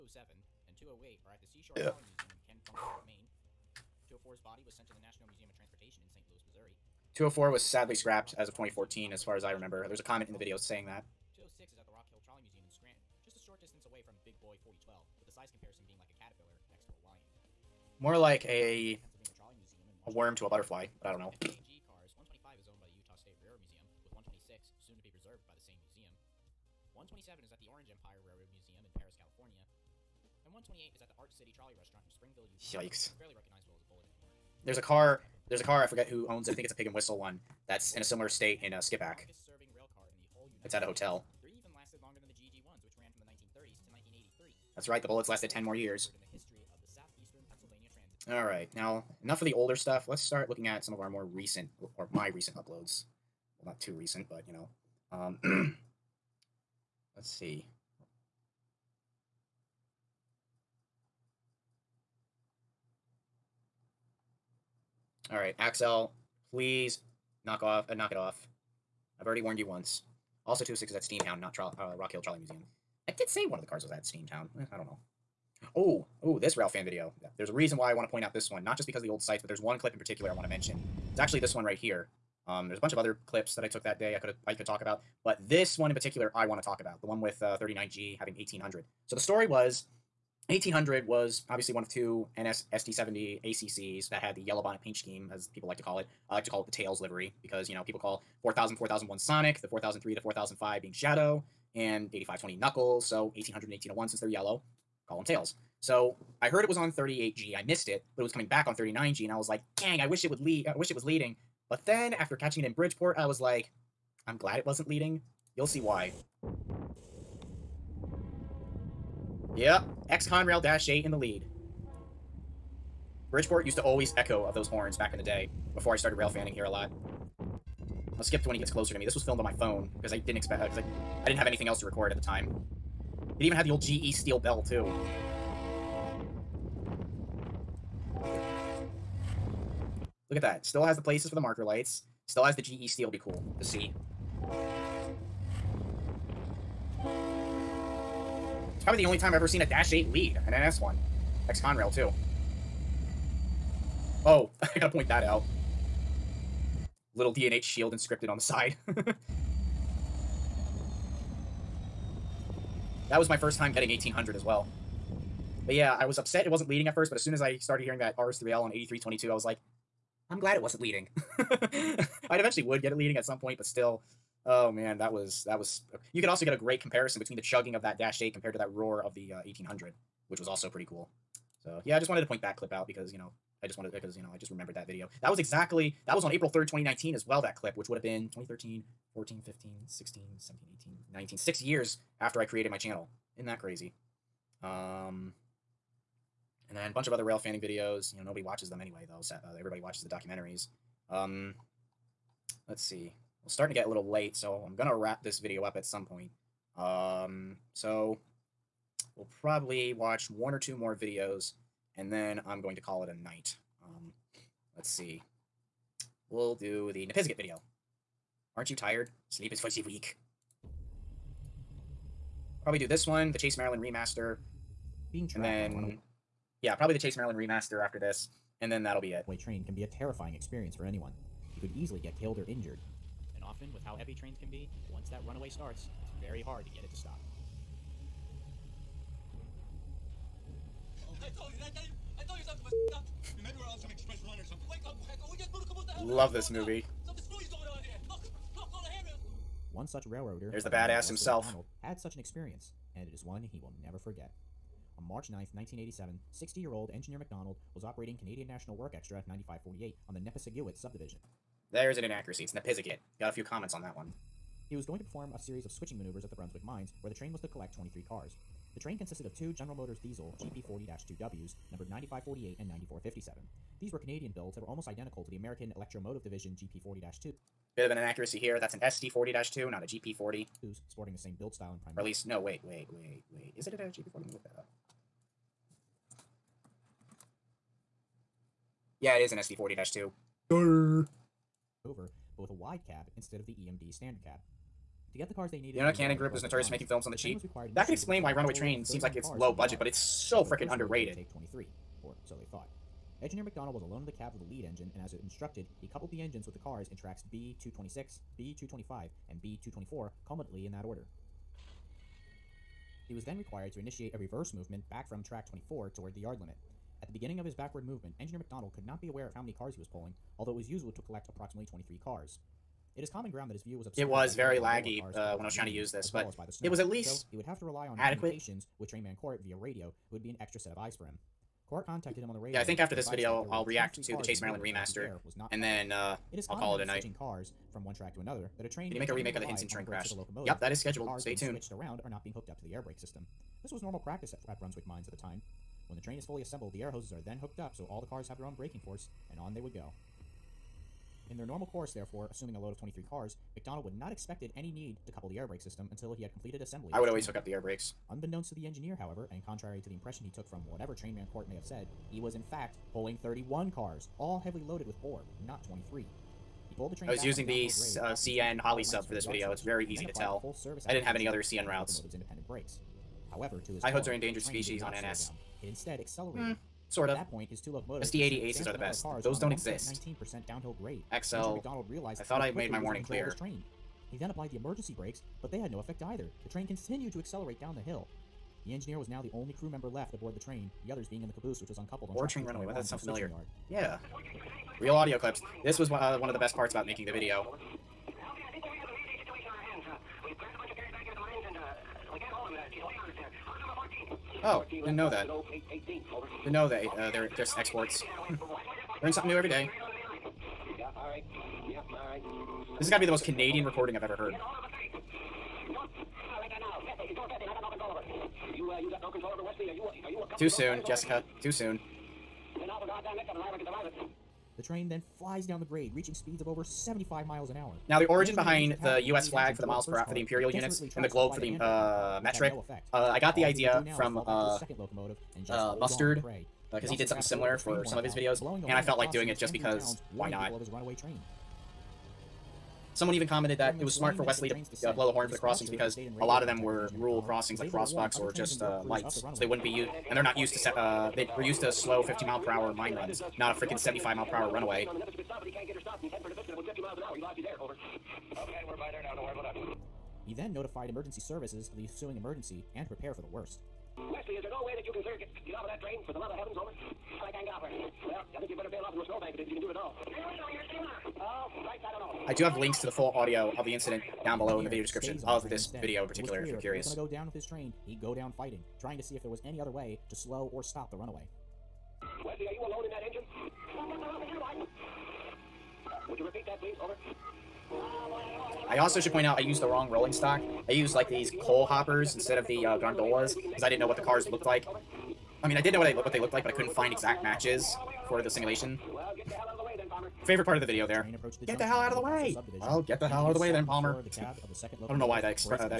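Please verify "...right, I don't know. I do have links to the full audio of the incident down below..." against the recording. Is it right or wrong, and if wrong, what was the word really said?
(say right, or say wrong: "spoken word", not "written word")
right.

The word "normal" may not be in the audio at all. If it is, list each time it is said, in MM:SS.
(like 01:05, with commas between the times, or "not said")
05:43, 05:51.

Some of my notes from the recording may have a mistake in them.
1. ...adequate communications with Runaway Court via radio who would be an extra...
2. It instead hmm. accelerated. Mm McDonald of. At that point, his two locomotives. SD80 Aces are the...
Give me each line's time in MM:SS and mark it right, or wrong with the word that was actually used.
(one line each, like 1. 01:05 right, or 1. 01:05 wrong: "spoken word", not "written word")
1. 05:27 wrong: "Trainman", not "Runaway"
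2. 06:15 wrong: "Sort", not "McDonald".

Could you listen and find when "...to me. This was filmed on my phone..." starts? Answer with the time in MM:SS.
02:08.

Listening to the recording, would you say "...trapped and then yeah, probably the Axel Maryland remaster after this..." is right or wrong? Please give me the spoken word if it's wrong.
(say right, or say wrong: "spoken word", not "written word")
wrong: "Chase", not "Axel".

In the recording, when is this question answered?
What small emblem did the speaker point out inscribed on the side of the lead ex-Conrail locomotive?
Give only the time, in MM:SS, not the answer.
02:37.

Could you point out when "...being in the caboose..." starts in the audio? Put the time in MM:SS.
06:31.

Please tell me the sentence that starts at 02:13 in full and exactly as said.
It even had the old GE steel bell, too.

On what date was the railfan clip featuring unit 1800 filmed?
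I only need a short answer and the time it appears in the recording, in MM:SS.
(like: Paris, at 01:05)
April 3, 2019, at 03:06.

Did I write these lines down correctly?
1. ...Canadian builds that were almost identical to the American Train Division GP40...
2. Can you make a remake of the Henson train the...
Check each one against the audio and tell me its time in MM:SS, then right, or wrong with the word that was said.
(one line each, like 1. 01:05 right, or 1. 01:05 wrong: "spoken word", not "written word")
1. 04:33 wrong: "Electromotive", not "Train"
2. 05:38 right.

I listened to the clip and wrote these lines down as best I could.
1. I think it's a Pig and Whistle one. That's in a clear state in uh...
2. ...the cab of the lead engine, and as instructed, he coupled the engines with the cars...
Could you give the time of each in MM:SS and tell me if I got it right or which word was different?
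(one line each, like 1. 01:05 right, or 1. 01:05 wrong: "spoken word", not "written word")
1. 00:36 wrong: "similar", not "clear"
2. 05:04 right.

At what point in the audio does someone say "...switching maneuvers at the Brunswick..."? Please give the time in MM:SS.
04:25.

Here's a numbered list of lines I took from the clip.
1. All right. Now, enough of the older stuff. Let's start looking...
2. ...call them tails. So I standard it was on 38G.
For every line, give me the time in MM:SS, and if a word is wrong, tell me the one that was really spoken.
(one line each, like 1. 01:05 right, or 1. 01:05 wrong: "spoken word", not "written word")
1. 00:48 right
2. 01:45 wrong: "heard", not "standard".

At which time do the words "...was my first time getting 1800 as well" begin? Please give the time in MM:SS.
02:43.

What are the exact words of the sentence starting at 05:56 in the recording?
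I would always hook up the air brakes.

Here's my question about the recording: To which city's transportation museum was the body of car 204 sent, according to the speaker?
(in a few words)
St. Louis.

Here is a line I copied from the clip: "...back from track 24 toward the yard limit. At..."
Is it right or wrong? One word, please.
right.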